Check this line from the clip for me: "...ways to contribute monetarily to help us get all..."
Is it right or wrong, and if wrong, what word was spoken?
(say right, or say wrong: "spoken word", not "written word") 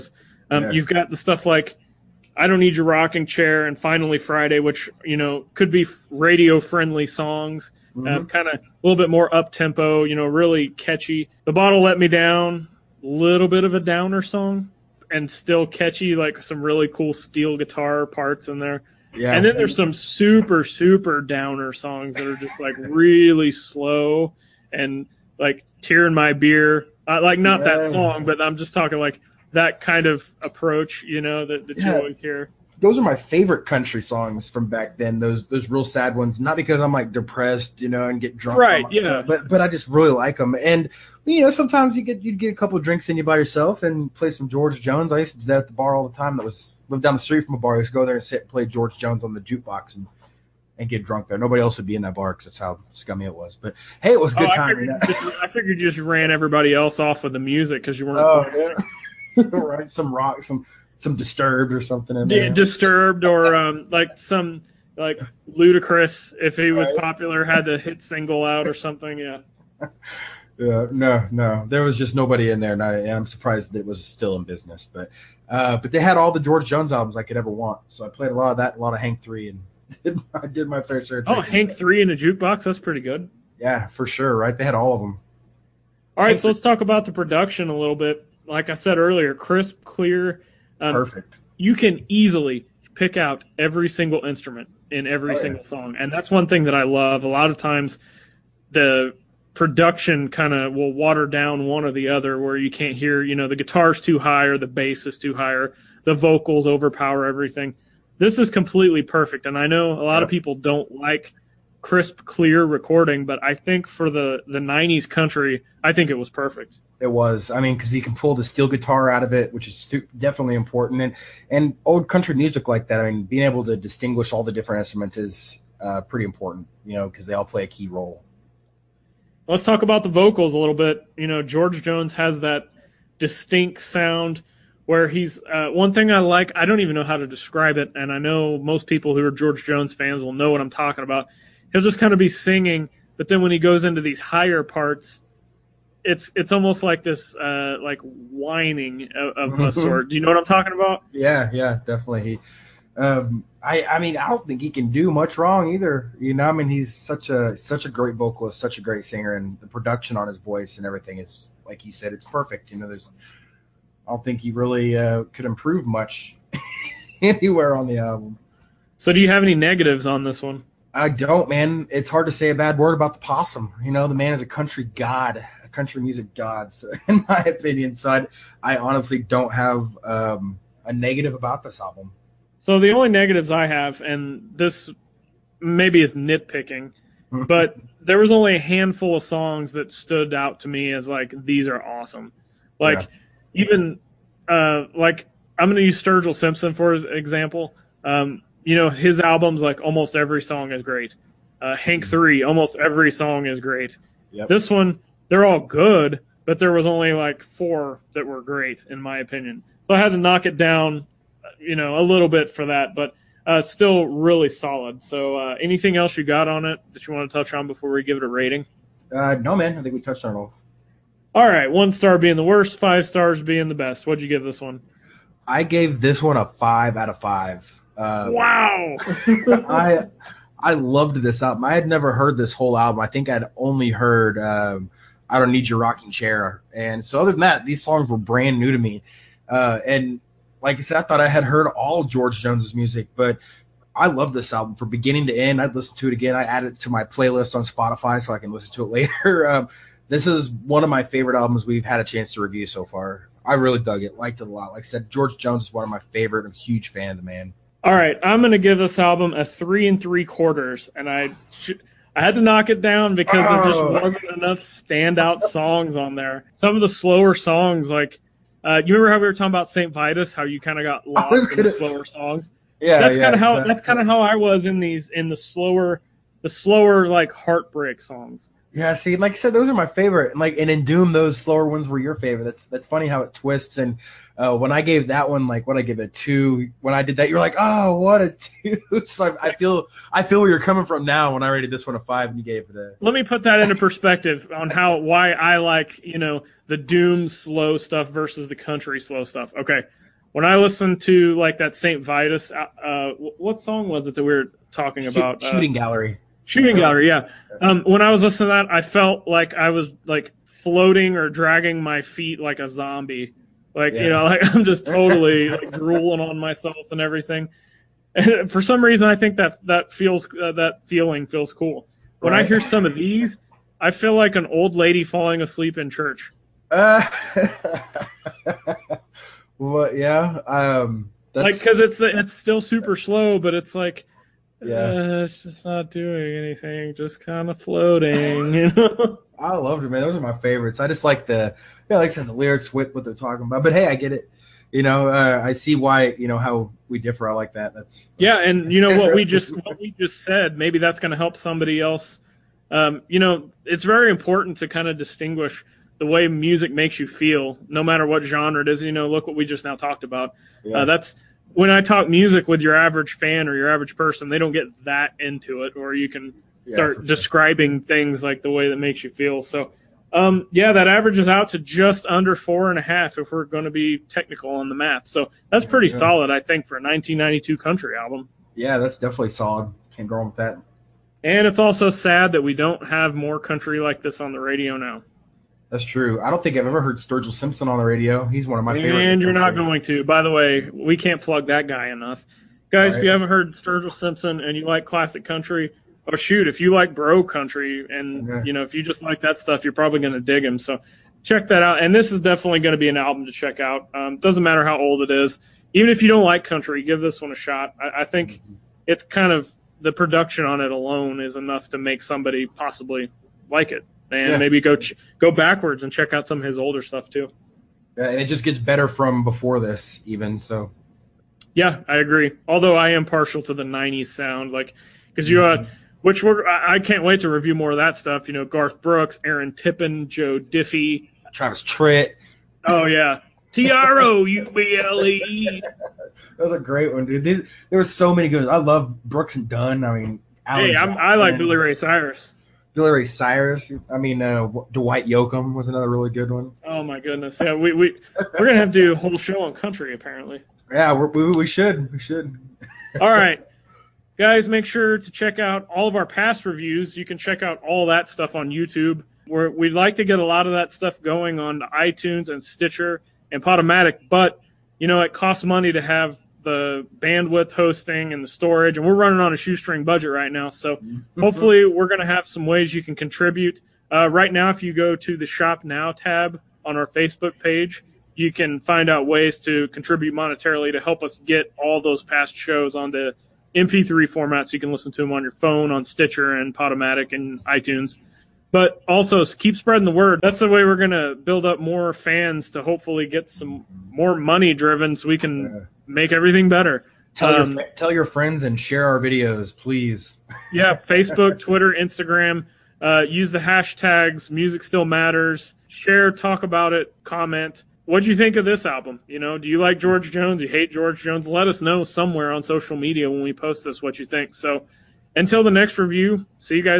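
right.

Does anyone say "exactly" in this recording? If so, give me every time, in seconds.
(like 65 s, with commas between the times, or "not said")
273 s.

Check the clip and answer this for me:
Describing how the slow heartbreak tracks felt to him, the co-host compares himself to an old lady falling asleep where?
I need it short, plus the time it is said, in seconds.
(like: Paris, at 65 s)
In church, at 325 s.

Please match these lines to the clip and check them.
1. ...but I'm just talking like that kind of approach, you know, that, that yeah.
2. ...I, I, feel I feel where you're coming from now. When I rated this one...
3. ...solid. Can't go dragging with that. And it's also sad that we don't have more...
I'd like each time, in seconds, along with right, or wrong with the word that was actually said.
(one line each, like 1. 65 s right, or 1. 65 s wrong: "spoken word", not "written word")
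1. 28 s right
2. 289 s right
3. 379 s wrong: "wrong", not "dragging".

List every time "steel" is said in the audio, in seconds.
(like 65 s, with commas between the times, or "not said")
17 s, 118 s.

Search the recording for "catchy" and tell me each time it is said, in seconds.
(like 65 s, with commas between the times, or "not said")
10 s, 15 s.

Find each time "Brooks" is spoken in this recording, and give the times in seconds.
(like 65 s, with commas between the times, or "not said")
428 s, 439 s.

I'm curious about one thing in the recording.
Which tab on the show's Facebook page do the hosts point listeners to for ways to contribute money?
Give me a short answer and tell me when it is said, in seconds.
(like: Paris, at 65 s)
Shop now, at 475 s.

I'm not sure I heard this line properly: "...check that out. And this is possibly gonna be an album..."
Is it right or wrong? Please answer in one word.
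wrong.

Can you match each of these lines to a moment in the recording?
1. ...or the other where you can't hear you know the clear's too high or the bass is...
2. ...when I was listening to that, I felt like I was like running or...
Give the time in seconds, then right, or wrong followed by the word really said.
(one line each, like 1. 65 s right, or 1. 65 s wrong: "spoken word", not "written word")
1. 101 s wrong: "guitar", not "clear"
2. 307 s wrong: "floating", not "running".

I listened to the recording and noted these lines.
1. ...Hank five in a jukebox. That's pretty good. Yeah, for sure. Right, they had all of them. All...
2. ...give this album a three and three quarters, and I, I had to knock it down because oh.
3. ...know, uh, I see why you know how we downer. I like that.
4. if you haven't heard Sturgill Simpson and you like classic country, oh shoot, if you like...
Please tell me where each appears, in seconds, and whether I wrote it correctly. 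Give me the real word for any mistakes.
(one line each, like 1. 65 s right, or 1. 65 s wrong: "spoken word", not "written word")
1. 81 s wrong: "three", not "five"
2. 258 s right
3. 344 s wrong: "differ", not "downer"
4. 392 s right.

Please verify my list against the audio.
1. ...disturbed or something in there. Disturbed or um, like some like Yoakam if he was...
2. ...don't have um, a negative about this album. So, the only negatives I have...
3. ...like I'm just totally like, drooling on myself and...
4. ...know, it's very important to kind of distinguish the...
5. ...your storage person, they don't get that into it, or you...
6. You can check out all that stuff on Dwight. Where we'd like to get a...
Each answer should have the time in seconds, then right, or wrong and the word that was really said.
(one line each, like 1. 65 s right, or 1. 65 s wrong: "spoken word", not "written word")
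1. 61 s wrong: "Ludacris", not "Yoakam"
2. 179 s right
3. 314 s right
4. 353 s right
5. 363 s wrong: "average", not "storage"
6. 456 s wrong: "YouTube", not "Dwight".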